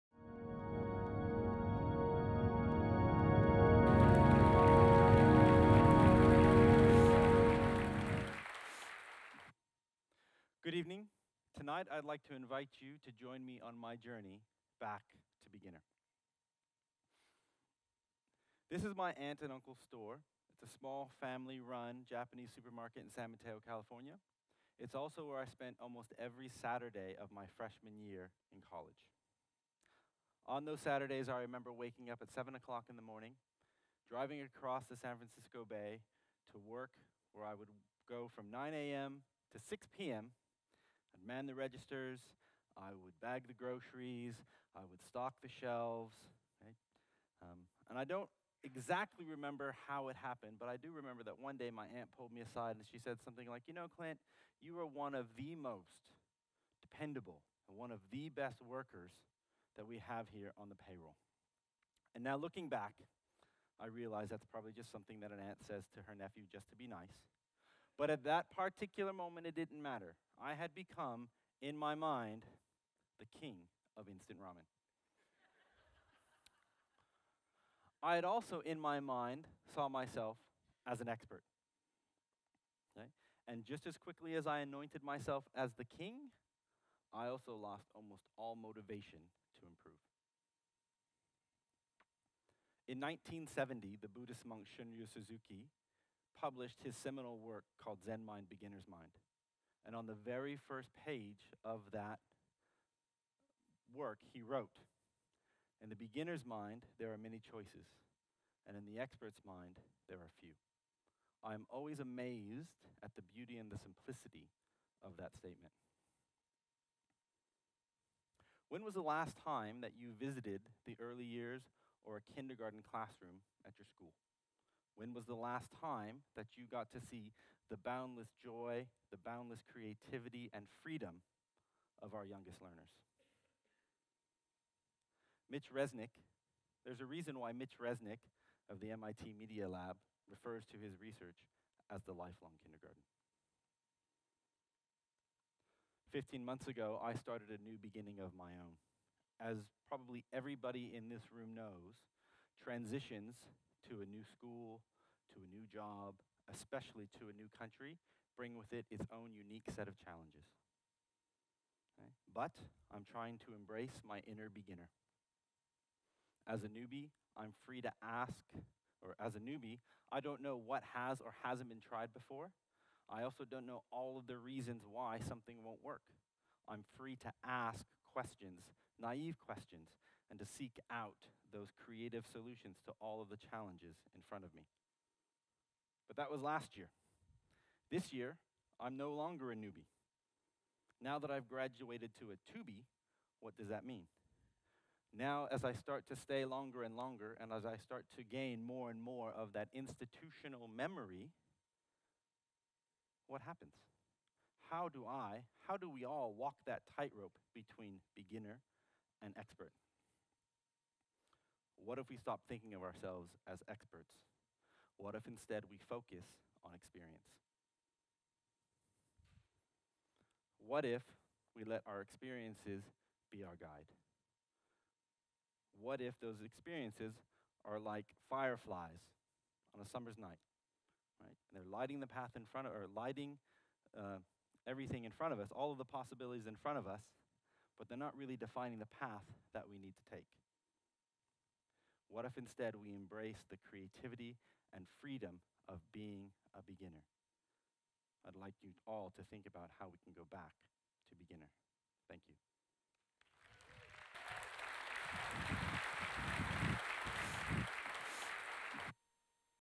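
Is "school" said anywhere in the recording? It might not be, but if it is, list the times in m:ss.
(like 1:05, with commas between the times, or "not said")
2:03, 2:34.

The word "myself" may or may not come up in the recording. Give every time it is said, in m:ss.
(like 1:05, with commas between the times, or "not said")
1:19, 1:25.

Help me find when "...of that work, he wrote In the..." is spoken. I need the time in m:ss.
1:41.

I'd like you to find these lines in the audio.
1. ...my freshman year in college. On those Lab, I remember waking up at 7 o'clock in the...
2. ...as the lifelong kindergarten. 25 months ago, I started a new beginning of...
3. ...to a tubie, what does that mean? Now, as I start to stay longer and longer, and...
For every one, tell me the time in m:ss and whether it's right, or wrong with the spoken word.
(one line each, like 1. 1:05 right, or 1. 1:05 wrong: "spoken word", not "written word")
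1. 0:27 wrong: "Saturdays", not "Lab"
2. 2:21 wrong: "15", not "25"
3. 3:12 right.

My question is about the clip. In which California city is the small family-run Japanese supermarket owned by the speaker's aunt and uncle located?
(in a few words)
San Mateo.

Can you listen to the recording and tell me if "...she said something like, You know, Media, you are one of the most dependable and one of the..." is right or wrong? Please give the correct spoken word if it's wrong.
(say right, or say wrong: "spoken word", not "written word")
wrong: "Clint", not "Media".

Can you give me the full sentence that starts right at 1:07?
But at that particular moment, it didn't matter.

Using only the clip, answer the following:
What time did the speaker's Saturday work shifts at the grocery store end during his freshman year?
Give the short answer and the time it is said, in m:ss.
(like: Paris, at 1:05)
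6 p.m., at 0:39.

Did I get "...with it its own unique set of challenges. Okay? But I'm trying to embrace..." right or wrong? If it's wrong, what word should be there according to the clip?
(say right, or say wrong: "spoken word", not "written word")
right.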